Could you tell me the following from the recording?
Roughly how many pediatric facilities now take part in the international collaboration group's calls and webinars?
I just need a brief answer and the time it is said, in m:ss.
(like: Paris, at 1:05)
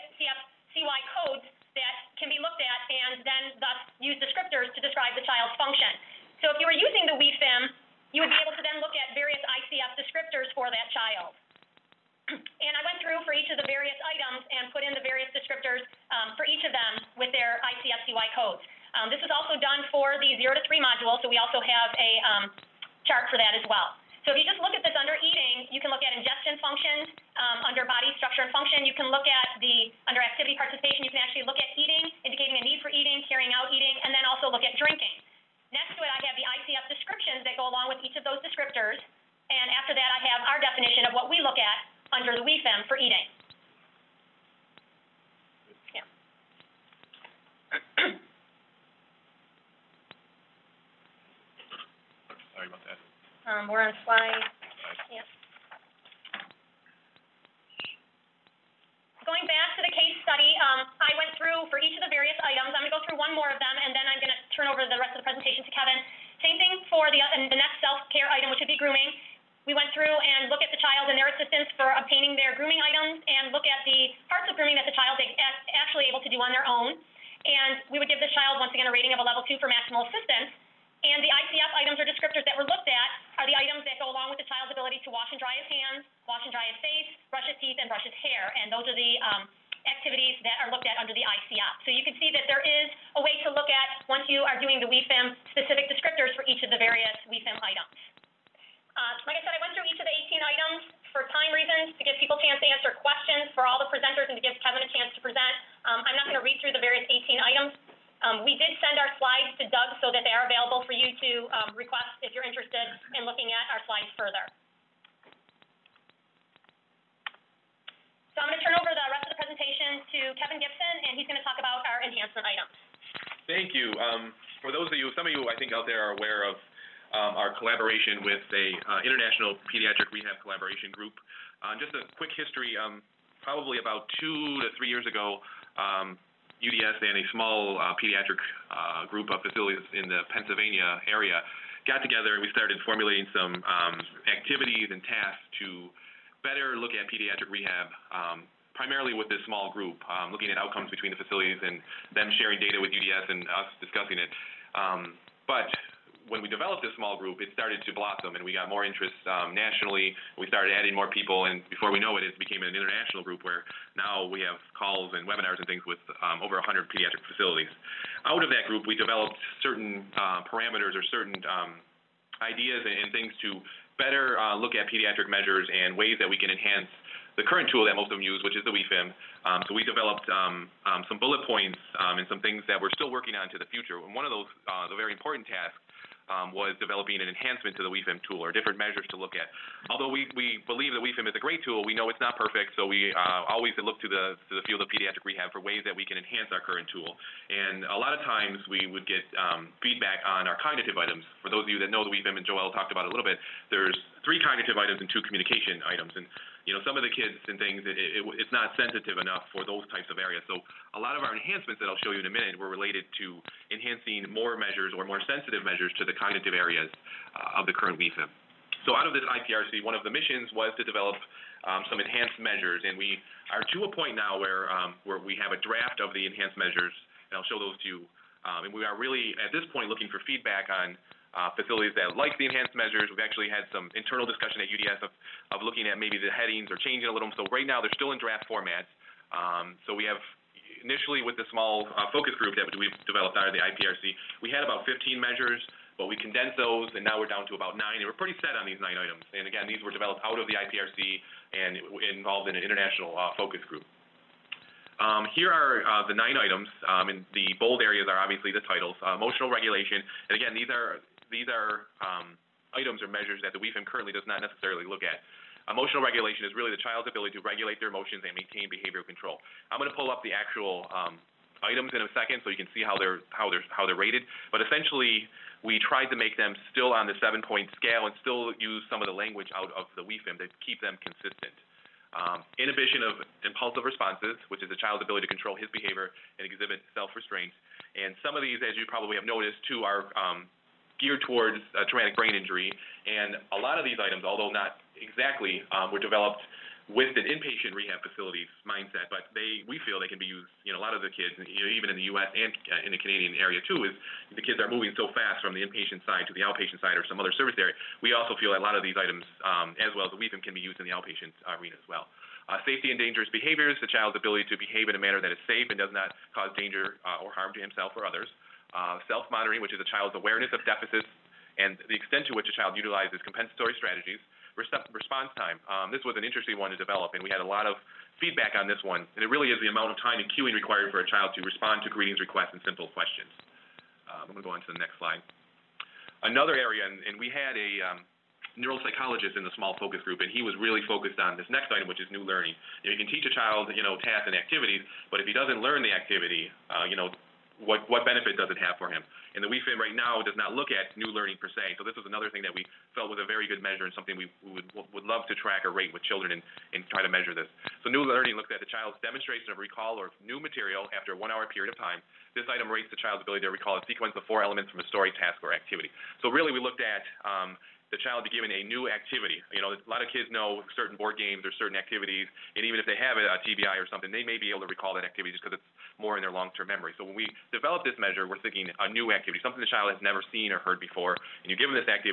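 over 100, at 2:46.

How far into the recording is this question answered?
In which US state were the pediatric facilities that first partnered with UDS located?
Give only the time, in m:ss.
2:20.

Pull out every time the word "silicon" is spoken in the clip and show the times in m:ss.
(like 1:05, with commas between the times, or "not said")
not said.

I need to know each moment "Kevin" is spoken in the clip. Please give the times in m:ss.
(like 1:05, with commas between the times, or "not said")
1:05, 1:44, 2:00.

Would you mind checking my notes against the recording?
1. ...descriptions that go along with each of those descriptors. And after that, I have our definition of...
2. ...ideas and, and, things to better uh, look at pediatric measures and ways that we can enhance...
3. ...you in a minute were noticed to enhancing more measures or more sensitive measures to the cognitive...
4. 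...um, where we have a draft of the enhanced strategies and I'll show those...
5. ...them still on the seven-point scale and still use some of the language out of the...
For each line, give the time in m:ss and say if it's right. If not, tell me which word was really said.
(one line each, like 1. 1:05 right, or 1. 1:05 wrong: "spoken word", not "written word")
1. 0:36 right
2. 2:52 right
3. 3:32 wrong: "related", not "noticed"
4. 3:44 wrong: "measures", not "strategies"
5. 4:36 right.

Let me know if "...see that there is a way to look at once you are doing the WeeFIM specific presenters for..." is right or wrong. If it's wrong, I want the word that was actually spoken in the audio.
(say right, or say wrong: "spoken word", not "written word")
wrong: "descriptors", not "presenters".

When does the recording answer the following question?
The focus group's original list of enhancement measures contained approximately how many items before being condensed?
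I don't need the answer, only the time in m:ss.
4:04.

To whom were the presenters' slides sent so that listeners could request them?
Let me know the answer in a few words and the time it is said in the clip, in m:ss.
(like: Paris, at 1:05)
Doug, at 1:49.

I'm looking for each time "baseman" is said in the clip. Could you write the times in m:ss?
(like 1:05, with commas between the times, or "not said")
not said.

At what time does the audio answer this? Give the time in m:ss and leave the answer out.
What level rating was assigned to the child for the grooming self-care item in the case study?
1:19.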